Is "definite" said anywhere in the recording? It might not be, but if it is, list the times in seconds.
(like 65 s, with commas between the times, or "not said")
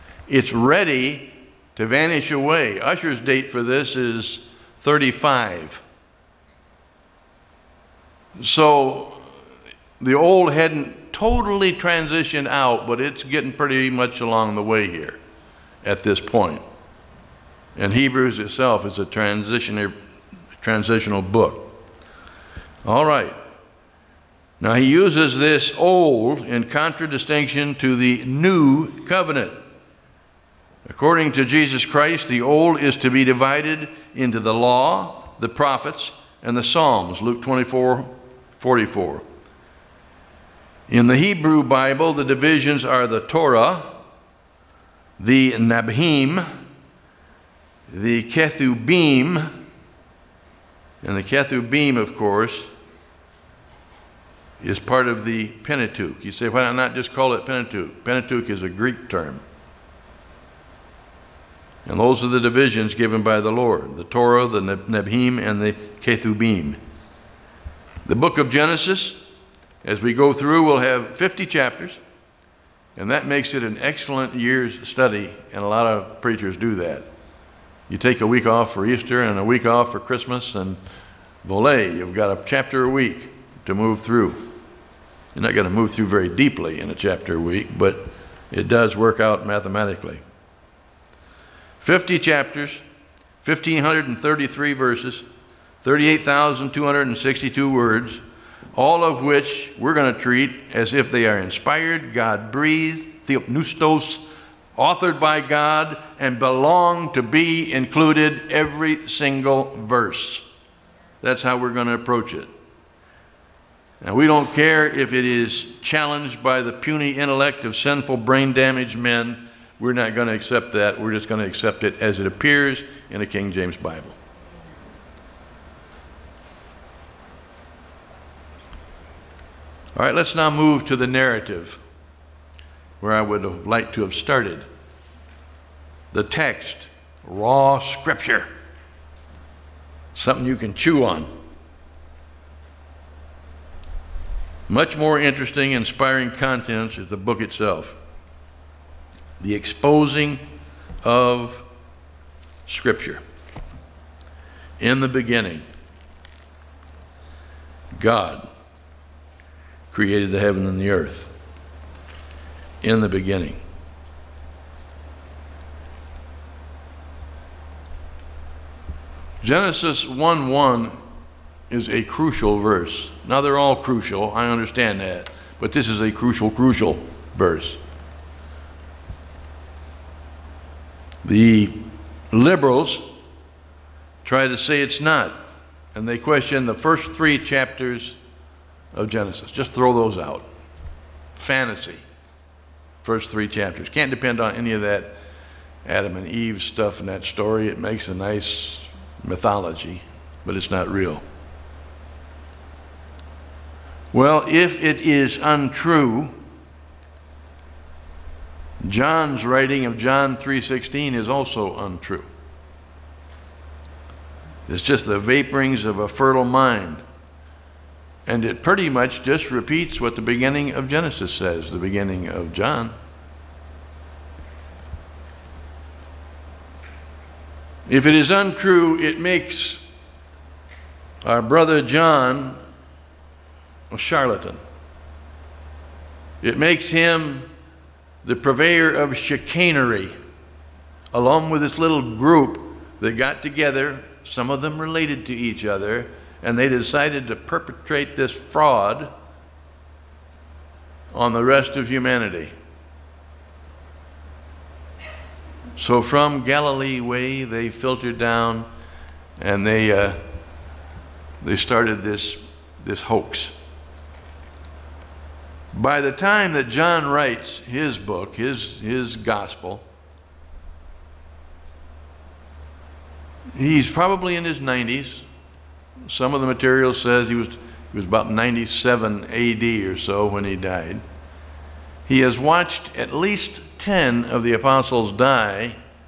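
not said.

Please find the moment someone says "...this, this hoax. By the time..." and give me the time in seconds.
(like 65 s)
262 s.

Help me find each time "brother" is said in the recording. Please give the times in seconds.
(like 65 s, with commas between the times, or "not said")
231 s.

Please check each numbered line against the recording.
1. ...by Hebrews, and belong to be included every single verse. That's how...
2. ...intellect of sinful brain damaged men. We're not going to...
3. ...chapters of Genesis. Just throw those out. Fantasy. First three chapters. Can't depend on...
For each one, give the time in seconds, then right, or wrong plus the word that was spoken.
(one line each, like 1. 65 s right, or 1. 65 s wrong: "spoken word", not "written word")
1. 105 s wrong: "God", not "Hebrews"
2. 117 s right
3. 187 s right.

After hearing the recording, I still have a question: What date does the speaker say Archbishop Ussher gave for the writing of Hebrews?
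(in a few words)
35.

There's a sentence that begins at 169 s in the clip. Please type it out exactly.
Genesis 1 1 is a crucial verse.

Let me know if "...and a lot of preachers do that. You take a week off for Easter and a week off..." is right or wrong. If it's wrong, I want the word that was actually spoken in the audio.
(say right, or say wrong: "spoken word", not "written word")
right.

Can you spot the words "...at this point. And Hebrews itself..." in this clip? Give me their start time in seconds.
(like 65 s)
15 s.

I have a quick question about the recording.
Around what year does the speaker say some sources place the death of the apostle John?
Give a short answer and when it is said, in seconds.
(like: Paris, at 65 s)
97 AD, at 278 s.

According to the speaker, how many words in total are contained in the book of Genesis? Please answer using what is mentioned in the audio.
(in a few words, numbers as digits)
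38,262.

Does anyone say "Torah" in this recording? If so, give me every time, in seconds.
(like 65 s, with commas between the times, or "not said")
43 s, 64 s.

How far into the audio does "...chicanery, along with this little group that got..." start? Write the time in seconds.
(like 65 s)
239 s.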